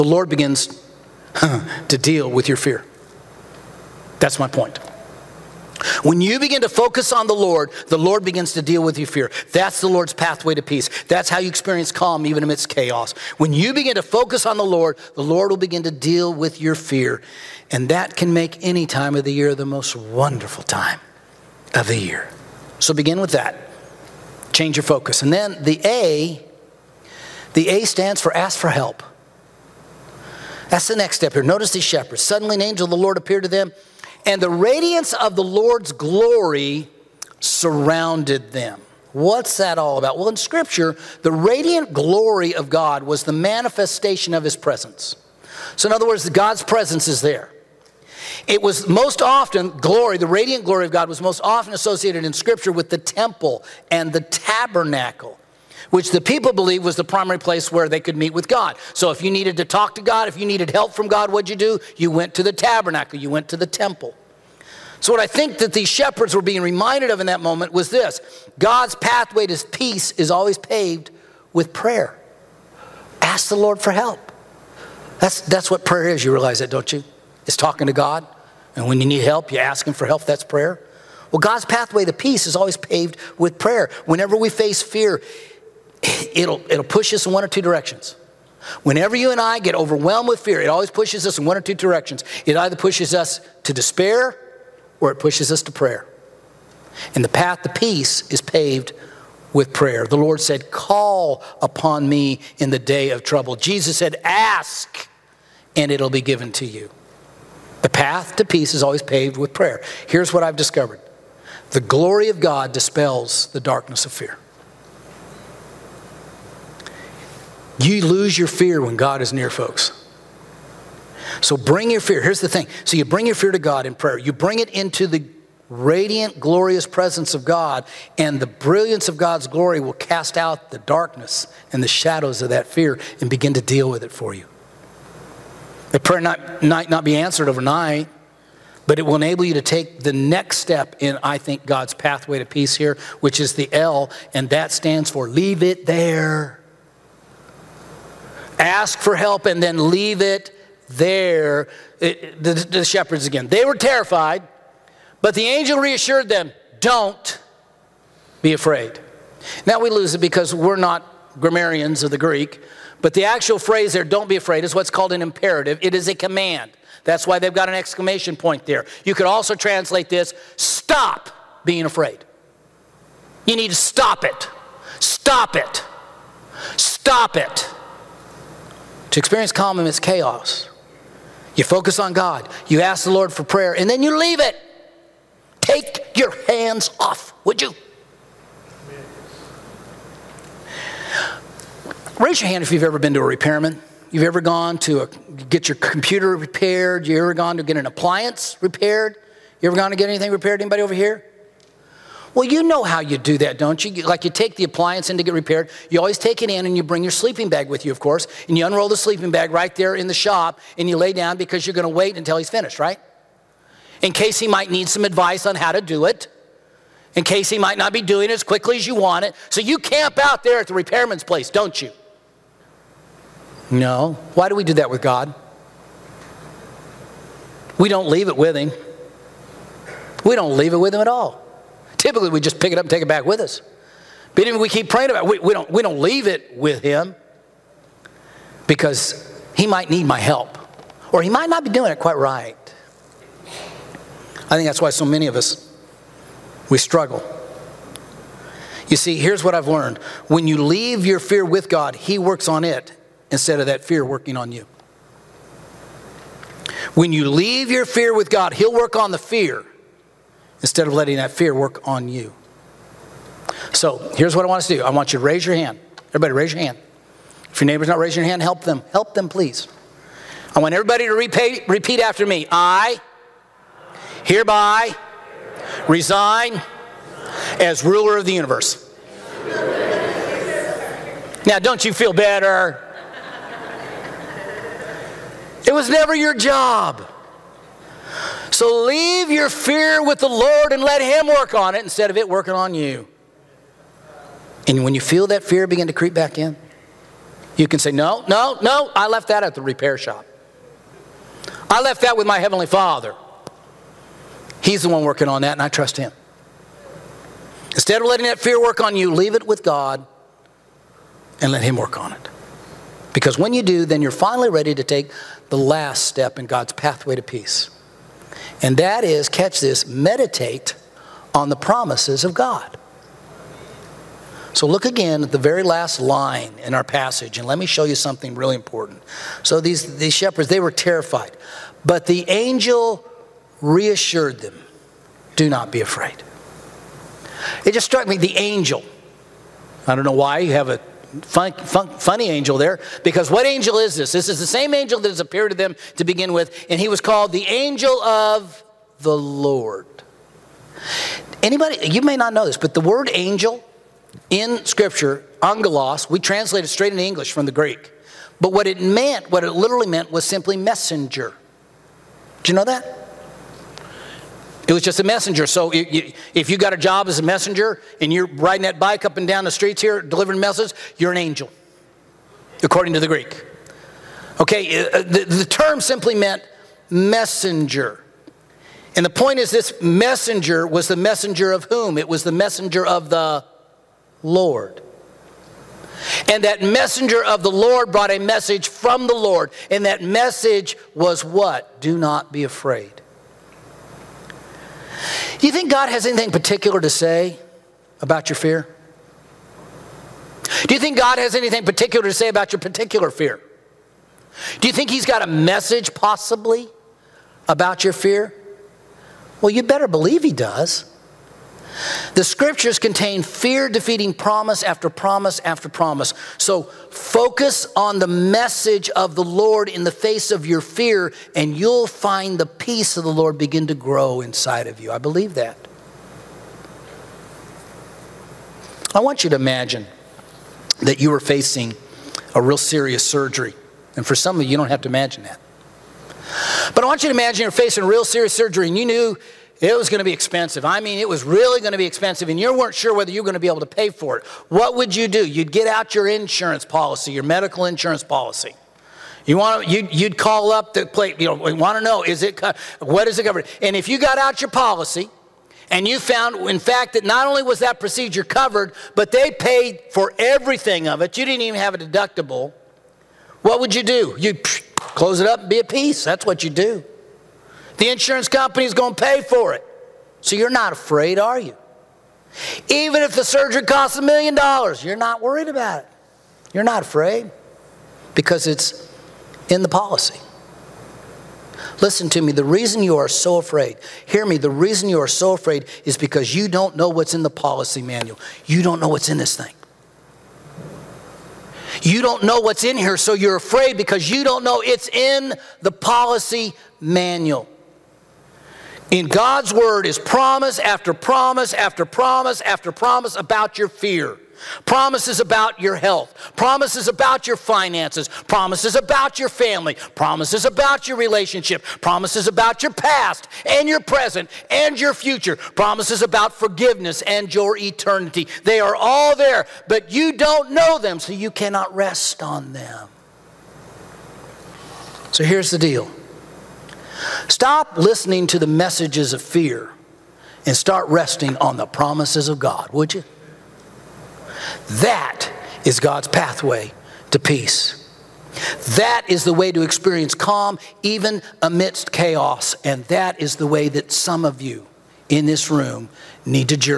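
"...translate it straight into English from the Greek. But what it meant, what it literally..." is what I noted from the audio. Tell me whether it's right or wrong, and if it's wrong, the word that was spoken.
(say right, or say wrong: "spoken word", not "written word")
right.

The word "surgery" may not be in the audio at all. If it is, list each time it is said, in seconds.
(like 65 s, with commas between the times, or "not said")
433 s, 438 s, 473 s.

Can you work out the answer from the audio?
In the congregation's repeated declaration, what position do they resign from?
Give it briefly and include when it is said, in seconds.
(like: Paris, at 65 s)
Ruler of the universe, at 277 s.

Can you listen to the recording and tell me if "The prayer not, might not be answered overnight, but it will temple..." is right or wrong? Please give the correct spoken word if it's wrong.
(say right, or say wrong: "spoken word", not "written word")
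wrong: "enable", not "temple".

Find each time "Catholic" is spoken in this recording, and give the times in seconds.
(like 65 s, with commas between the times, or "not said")
not said.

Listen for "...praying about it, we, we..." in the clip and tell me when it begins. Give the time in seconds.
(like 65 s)
234 s.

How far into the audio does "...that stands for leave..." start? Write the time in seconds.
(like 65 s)
144 s.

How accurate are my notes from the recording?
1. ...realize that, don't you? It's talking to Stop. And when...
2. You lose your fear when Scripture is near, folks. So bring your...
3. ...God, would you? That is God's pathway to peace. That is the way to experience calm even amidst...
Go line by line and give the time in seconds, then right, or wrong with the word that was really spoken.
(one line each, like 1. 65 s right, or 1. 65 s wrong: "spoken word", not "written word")
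1. 76 s wrong: "God", not "Stop"
2. 117 s wrong: "God", not "Scripture"
3. 532 s right.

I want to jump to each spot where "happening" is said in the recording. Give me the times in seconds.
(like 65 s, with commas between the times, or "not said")
not said.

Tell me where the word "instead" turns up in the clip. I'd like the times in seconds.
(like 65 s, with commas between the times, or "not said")
253 s, 260 s, 291 s, 307 s.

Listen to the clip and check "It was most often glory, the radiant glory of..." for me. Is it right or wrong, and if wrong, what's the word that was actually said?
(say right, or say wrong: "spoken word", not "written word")
right.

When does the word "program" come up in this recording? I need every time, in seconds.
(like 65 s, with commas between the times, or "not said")
not said.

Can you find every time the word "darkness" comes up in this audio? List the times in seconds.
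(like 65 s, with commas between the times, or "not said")
113 s, 130 s.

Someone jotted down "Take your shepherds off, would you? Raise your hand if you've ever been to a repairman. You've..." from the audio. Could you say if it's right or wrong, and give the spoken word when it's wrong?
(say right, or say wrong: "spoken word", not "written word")
wrong: "hands", not "shepherds".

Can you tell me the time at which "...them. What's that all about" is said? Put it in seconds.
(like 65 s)
38 s.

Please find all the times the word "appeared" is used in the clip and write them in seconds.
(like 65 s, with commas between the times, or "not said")
33 s, 345 s.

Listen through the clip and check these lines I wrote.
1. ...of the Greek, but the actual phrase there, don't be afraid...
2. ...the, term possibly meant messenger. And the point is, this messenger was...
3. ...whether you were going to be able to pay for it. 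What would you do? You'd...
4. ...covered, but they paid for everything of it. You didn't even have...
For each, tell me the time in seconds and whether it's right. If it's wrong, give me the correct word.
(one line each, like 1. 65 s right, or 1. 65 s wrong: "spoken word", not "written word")
1. 162 s right
2. 375 s wrong: "simply", not "possibly"
3. 442 s right
4. 458 s right.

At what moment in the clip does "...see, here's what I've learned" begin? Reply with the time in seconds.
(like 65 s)
248 s.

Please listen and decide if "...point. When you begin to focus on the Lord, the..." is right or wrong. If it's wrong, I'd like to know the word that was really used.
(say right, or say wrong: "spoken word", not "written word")
right.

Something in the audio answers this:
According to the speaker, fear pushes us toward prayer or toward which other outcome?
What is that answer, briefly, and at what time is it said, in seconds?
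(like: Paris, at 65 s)
Despair, at 93 s.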